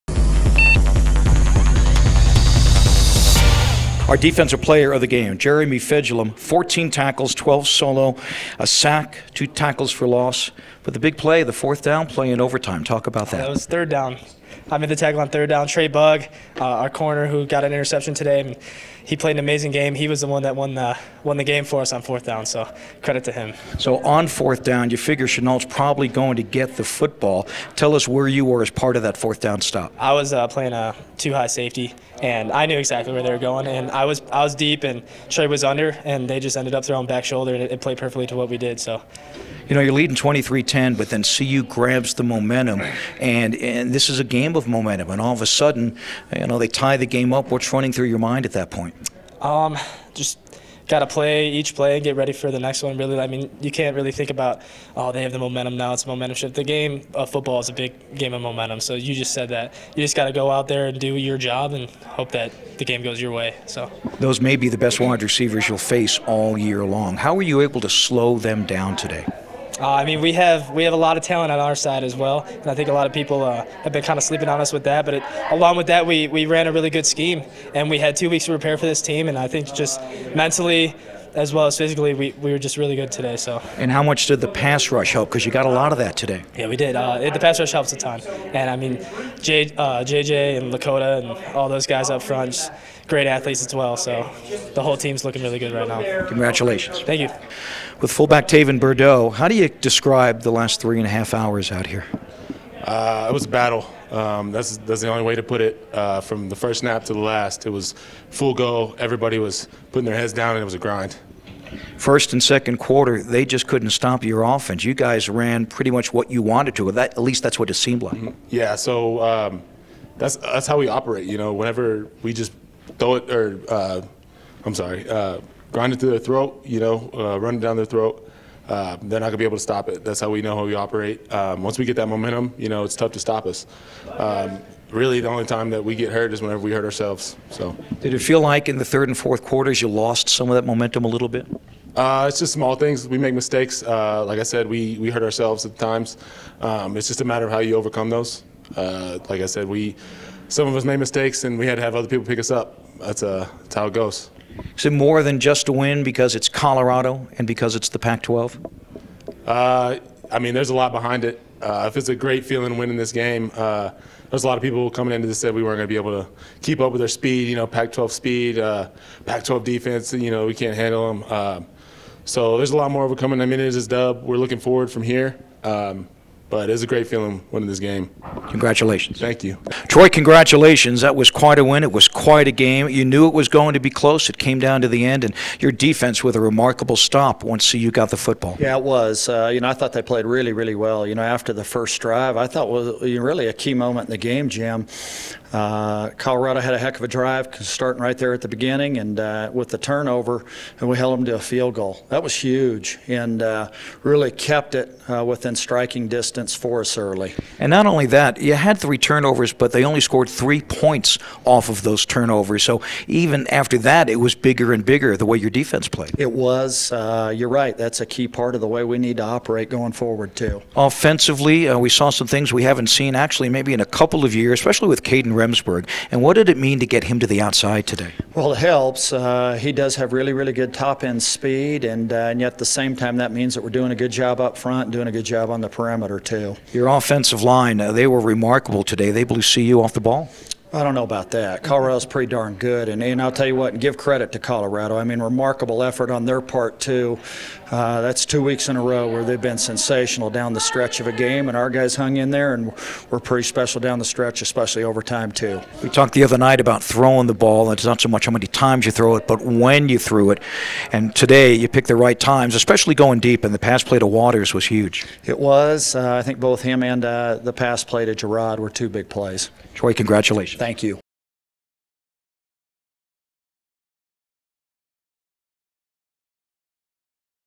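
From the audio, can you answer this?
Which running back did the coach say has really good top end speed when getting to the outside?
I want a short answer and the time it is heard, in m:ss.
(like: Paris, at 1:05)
Kadin Remsberg, at 3:45.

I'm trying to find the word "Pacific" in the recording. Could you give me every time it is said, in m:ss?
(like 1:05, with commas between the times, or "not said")
not said.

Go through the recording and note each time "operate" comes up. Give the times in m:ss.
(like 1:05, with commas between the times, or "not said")
2:00, 2:10, 3:39.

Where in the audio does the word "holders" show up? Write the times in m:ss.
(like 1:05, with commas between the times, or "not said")
not said.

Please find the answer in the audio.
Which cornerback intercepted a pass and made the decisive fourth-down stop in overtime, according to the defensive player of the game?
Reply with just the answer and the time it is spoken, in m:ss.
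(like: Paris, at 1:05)
Trey Bugg, at 0:15.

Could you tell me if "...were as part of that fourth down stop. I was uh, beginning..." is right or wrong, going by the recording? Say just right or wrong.
wrong.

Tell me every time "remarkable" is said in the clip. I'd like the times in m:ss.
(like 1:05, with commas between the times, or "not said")
3:06, 3:58, 4:05.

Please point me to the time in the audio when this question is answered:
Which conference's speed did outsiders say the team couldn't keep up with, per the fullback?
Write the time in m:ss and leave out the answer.
2:47.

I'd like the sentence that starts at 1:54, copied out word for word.
You guys ran pretty much what you wanted to.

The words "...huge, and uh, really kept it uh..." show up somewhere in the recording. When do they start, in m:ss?
3:22.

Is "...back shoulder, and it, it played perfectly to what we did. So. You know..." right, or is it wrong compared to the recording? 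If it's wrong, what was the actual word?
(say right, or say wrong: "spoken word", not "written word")
right.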